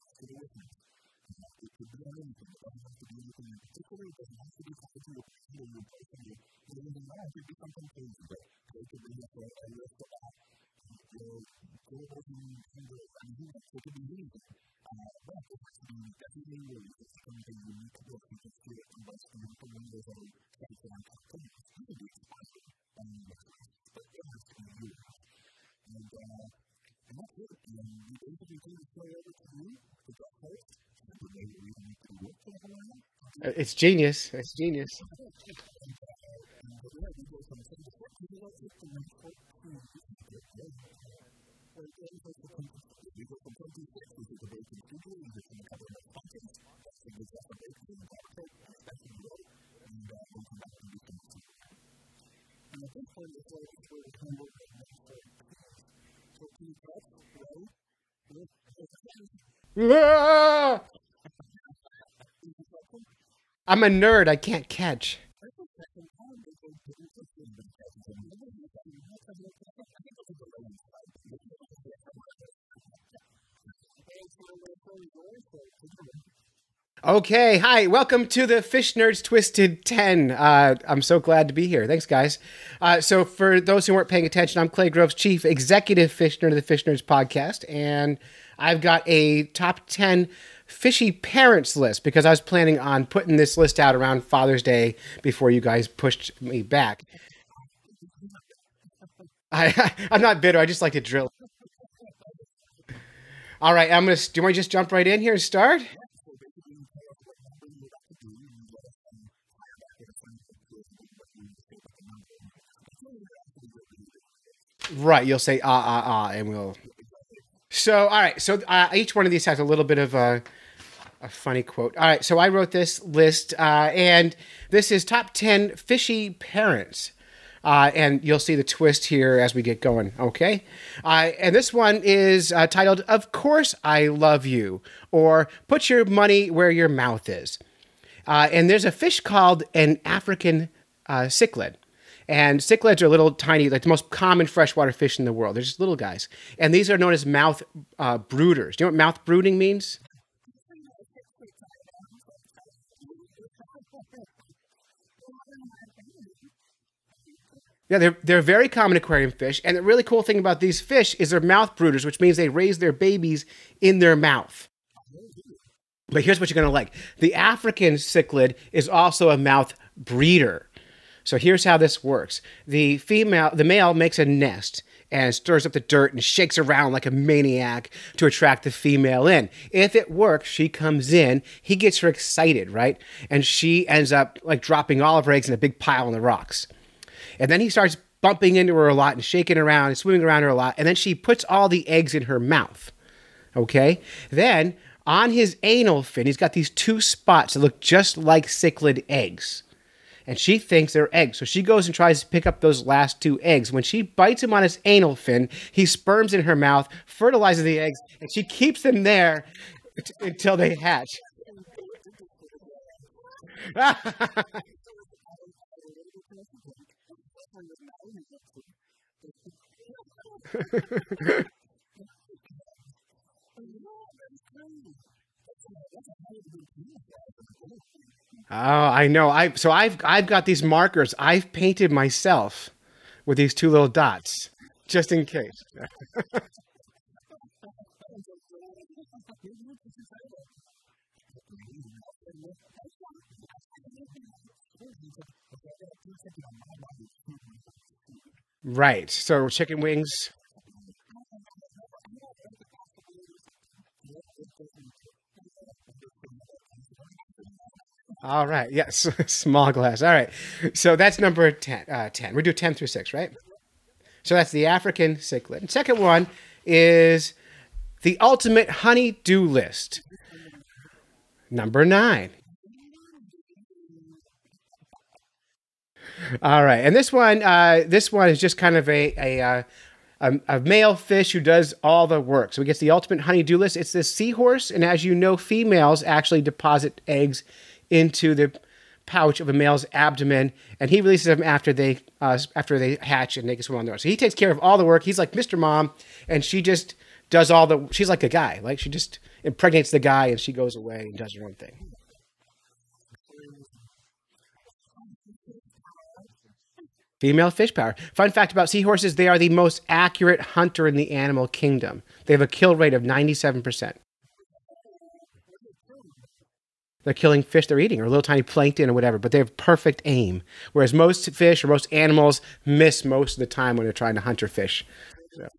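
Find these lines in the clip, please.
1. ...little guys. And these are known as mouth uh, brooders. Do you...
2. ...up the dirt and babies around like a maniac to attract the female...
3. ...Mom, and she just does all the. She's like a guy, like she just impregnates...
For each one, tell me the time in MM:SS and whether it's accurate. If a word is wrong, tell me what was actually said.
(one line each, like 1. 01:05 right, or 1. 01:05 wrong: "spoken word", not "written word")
1. 02:25 right
2. 02:55 wrong: "shakes", not "babies"
3. 04:55 right.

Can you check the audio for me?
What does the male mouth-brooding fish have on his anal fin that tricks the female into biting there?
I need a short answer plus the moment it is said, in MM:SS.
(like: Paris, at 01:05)
Two spots, at 03:16.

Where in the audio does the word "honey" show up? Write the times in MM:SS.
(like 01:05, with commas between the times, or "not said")
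04:28, 04:43.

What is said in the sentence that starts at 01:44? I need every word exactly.
Do you want to just jump right in here and start?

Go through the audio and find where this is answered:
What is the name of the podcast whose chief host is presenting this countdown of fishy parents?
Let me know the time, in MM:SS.
01:26.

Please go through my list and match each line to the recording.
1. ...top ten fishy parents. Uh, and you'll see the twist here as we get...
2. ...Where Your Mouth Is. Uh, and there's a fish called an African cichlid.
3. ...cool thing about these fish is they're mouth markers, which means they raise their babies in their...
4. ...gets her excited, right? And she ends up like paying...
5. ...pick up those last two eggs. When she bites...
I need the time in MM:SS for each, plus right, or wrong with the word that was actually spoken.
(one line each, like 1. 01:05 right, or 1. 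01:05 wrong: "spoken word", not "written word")
1. 02:05 right
2. 02:16 right
3. 02:40 wrong: "brooders", not "markers"
4. 03:01 wrong: "dropping", not "paying"
5. 03:22 right.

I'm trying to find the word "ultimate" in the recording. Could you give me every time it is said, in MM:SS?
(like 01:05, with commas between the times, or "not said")
04:28, 04:42.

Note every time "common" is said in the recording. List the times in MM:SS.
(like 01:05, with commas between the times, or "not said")
02:24, 02:38.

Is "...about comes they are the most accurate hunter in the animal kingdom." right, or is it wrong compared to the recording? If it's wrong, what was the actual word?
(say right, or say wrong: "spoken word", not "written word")
wrong: "seahorses", not "comes".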